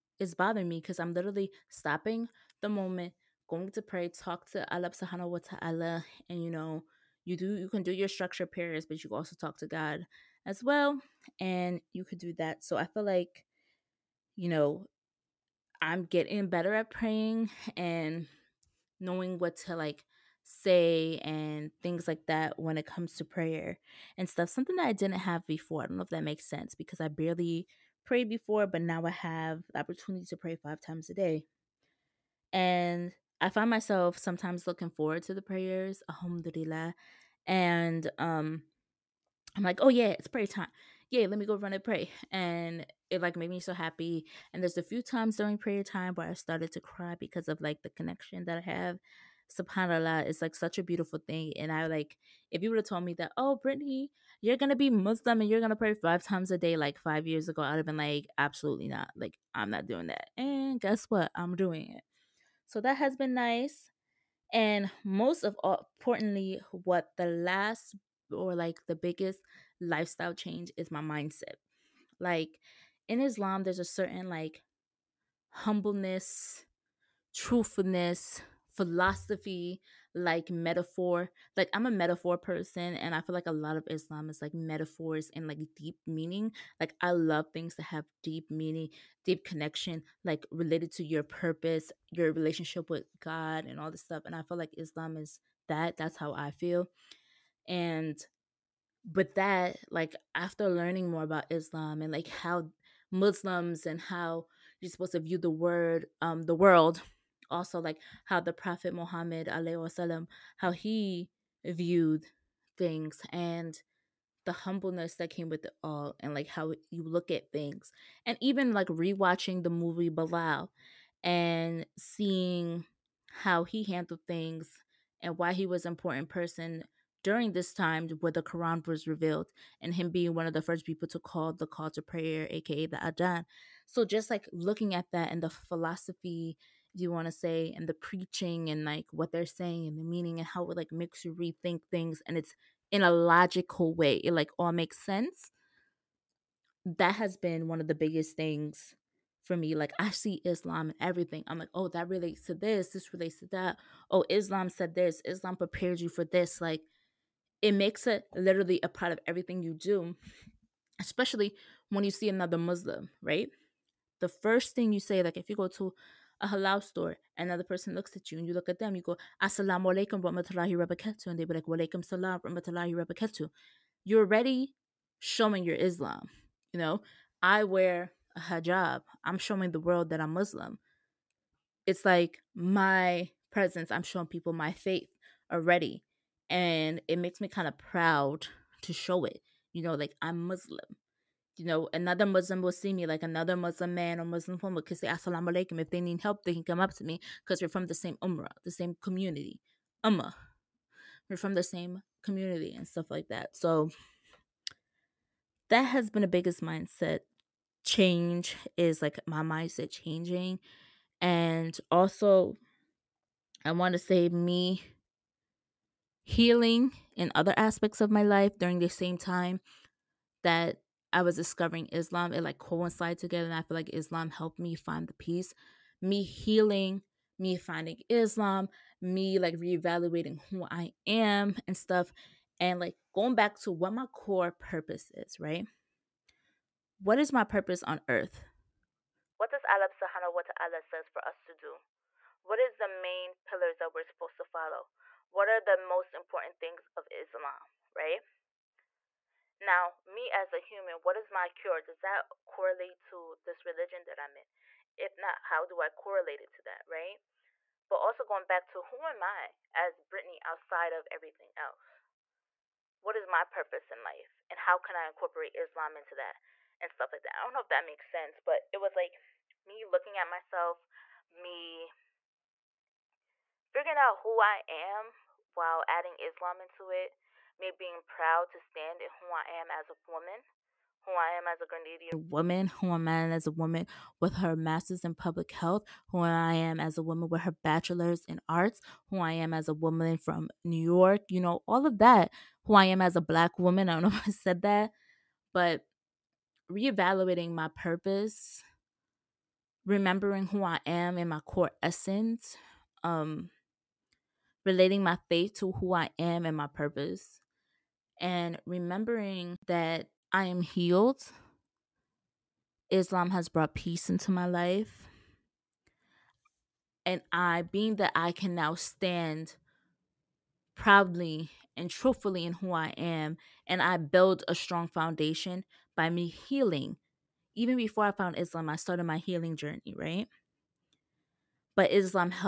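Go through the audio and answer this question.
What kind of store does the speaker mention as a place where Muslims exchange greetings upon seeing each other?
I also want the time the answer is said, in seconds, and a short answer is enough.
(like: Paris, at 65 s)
halal store, at 166 s.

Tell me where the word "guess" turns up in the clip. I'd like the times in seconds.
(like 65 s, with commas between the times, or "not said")
60 s.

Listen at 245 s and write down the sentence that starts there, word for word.
what are the most important things of Islam, right?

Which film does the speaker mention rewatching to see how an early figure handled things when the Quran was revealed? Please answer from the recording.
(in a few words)
Bilal.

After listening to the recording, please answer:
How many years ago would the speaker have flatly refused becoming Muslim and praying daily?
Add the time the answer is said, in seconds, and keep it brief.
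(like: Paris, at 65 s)
5, at 56 s.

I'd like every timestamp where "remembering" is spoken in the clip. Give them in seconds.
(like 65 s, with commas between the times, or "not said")
299 s, 308 s.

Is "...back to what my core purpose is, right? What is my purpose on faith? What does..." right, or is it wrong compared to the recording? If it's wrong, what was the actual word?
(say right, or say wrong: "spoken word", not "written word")
wrong: "earth", not "faith".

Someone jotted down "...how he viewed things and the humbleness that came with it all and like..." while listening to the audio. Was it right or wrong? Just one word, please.
right.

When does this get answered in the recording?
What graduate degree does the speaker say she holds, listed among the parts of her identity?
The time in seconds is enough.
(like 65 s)
284 s.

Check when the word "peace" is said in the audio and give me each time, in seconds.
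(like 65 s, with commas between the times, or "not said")
225 s, 313 s.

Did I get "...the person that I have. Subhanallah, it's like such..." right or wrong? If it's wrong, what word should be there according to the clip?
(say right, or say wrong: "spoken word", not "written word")
wrong: "connection", not "person".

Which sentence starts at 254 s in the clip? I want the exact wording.
If not, how do I correlate it to that, right?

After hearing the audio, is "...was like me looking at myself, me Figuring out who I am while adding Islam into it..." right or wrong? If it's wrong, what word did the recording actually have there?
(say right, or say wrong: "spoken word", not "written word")
right.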